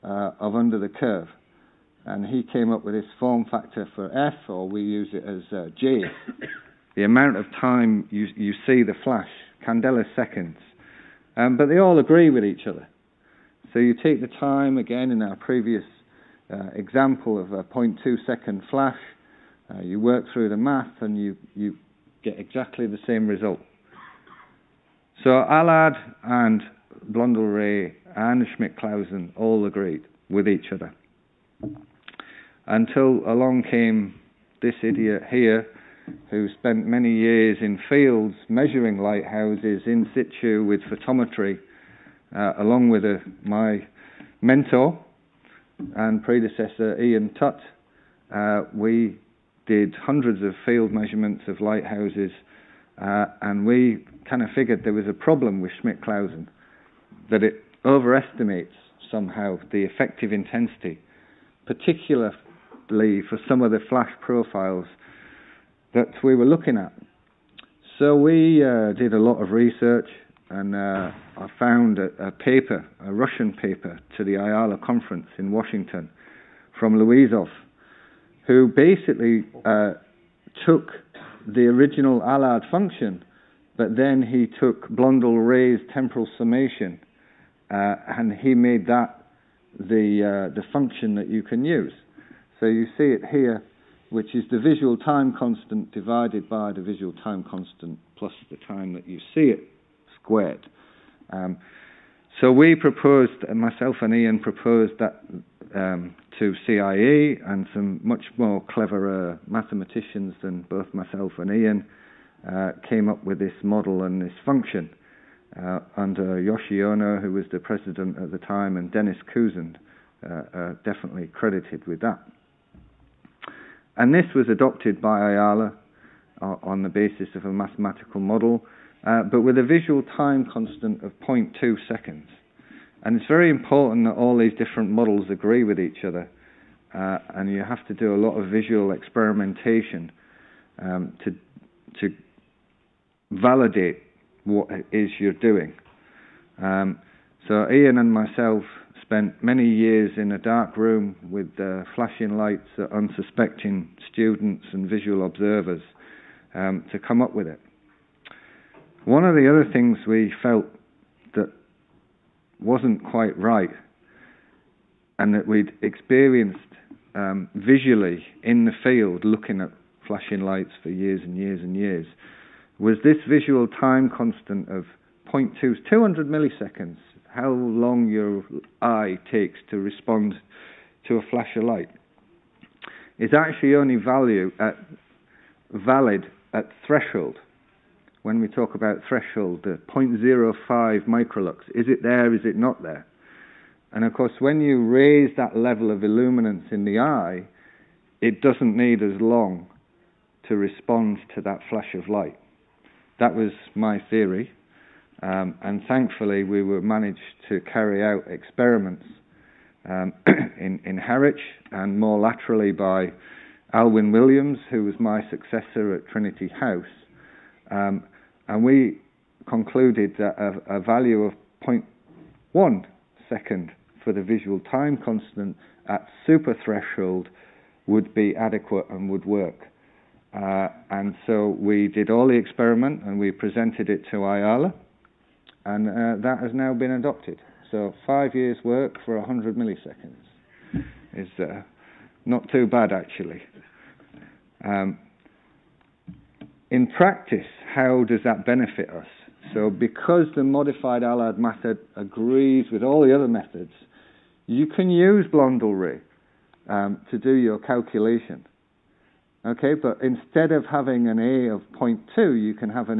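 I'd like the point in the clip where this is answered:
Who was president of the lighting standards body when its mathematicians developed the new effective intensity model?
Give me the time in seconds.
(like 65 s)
116 s.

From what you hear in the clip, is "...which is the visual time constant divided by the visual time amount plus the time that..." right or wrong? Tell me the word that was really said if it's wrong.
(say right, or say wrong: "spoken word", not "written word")
wrong: "constant", not "amount".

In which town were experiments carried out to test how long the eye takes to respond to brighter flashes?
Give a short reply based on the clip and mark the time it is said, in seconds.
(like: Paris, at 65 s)
Harwich, at 210 s.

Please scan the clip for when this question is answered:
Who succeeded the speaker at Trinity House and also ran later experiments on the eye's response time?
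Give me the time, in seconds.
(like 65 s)
213 s.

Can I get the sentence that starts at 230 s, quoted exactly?
Uh, and so we did all the experiment and we presented it to IALA, and uh, that has now been adopted.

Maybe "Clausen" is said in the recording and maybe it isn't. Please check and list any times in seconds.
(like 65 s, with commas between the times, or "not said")
28 s, 56 s.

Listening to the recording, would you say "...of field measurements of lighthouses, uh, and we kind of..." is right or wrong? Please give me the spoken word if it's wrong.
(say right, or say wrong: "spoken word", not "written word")
right.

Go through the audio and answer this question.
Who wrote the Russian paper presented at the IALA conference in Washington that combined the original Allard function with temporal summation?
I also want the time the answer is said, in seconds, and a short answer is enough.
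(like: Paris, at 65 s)
Luizov, at 76 s.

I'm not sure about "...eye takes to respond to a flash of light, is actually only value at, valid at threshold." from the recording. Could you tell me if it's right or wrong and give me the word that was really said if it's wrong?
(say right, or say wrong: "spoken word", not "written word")
right.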